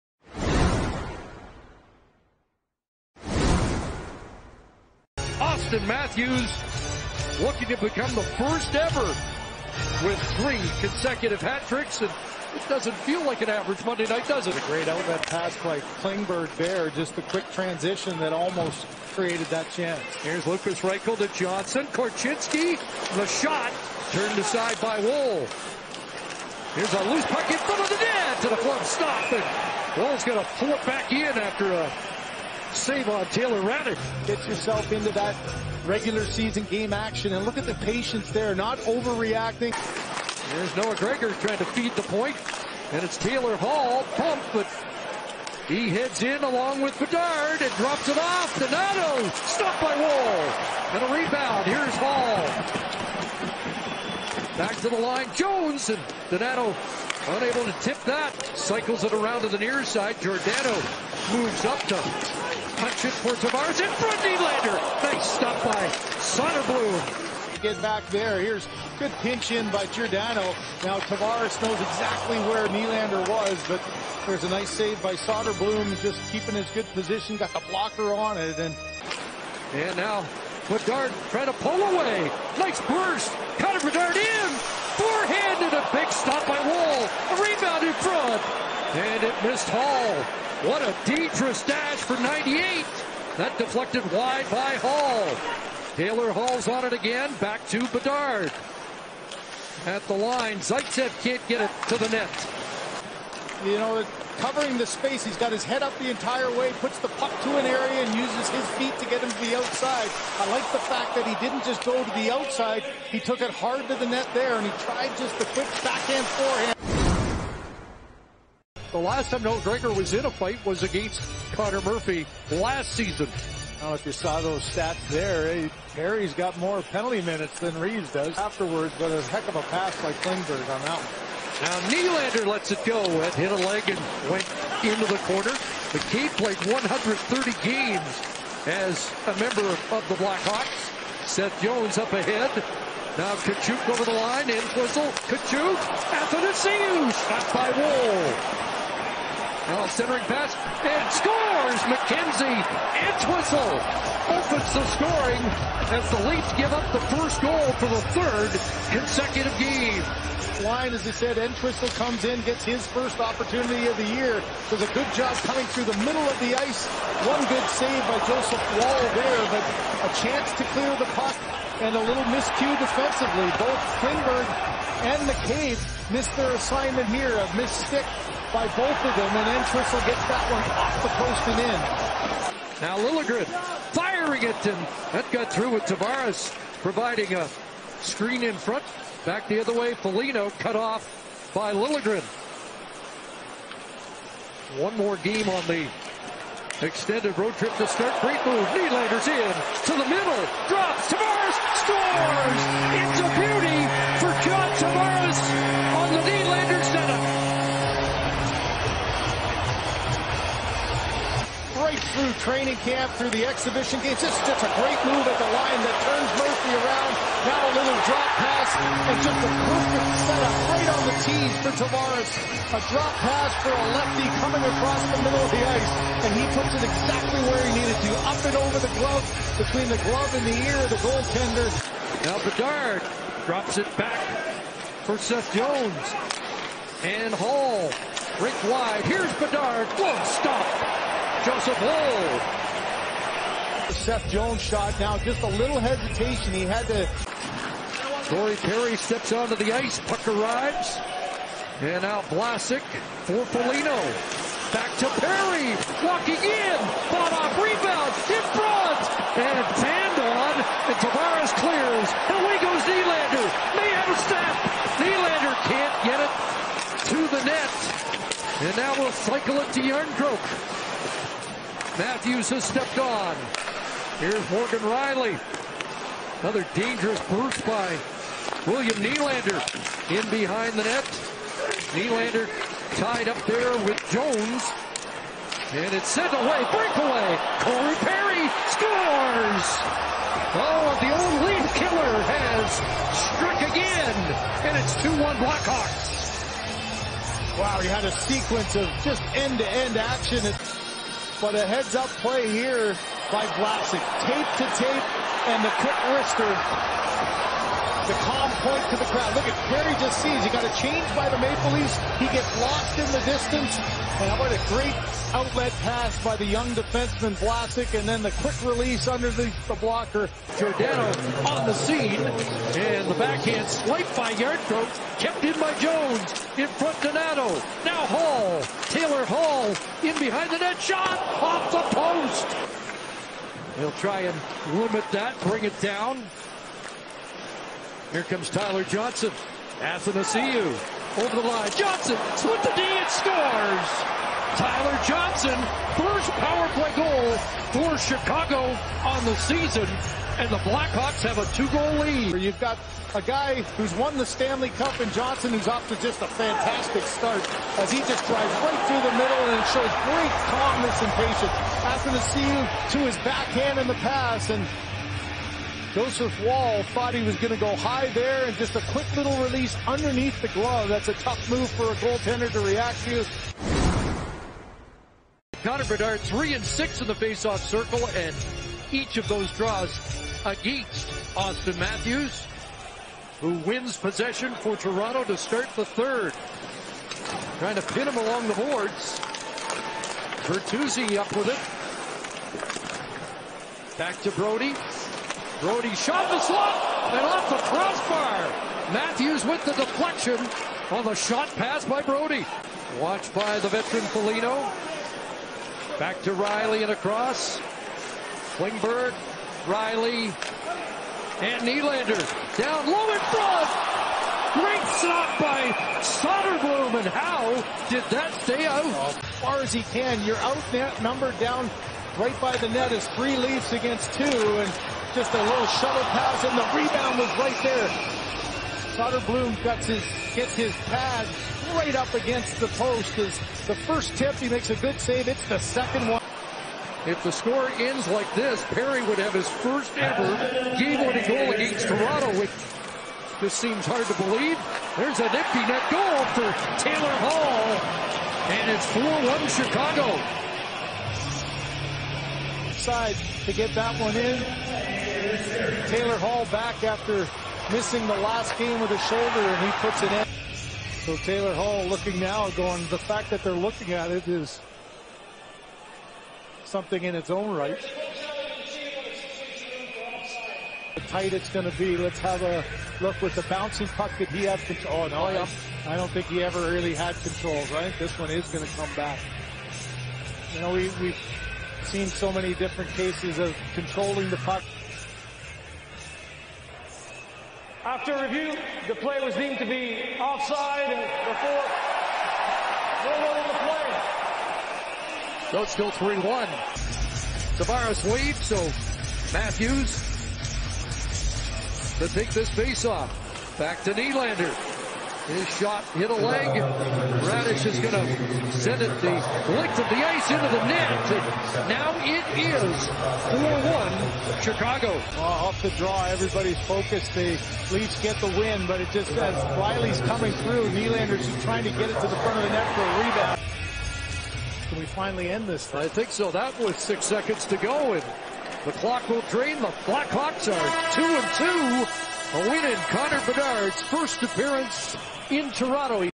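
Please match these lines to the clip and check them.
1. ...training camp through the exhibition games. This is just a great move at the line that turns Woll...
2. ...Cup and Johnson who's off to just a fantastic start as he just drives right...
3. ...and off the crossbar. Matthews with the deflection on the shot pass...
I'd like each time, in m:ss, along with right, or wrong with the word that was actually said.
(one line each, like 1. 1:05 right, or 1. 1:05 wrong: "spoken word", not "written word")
1. 3:32 wrong: "Murphy", not "Woll"
2. 5:54 right
3. 6:37 right.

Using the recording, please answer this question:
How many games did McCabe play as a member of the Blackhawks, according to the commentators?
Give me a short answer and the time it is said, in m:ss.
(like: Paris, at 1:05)
130, at 2:16.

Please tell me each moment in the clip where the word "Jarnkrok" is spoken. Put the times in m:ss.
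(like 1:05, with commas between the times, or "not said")
4:29, 5:24.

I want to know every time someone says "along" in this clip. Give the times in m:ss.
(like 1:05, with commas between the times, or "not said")
0:46, 6:28.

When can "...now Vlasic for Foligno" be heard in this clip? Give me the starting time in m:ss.
4:12.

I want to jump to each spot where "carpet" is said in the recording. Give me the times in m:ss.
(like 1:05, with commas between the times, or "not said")
not said.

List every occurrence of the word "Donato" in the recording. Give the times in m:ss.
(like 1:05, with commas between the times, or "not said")
0:48, 0:56.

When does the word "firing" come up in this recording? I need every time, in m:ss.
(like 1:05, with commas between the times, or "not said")
3:03.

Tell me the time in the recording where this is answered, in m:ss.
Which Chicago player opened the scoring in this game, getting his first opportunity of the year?
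2:31.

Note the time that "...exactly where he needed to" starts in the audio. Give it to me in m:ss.
3:46.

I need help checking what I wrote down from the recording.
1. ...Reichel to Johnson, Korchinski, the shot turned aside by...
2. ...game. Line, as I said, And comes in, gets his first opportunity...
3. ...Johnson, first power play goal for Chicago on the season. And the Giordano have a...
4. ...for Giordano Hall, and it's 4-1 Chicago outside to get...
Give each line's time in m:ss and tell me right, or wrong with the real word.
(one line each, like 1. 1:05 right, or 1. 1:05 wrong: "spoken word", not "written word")
1. 0:20 right
2. 2:39 wrong: "Entwistle", not "And"
3. 5:45 wrong: "Blackhawks", not "Giordano"
4. 7:26 wrong: "Taylor", not "Giordano".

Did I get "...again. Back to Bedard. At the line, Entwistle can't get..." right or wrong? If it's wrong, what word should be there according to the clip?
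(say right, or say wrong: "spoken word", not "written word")
wrong: "Zaitsev", not "Entwistle".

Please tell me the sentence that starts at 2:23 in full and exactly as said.
Now Kachuk over the line, in whistle, Kachuk, Athanasiu, shot by Woll.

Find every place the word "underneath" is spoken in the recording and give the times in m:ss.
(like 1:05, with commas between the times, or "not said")
5:19, 6:09.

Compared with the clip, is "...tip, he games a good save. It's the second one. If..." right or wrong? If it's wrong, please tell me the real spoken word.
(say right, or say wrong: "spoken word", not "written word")
wrong: "makes", not "games".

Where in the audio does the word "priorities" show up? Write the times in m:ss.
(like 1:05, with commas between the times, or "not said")
not said.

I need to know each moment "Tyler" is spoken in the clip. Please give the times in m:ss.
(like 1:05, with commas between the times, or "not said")
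5:38, 5:44.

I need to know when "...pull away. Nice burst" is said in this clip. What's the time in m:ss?
1:21.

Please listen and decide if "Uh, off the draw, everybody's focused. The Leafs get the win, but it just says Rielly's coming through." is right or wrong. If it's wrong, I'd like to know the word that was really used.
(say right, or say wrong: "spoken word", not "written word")
right.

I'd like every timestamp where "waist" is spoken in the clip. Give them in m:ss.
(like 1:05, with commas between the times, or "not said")
not said.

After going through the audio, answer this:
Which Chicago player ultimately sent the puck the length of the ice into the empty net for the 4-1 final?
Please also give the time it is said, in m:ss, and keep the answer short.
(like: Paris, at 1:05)
Raddysh, at 8:26.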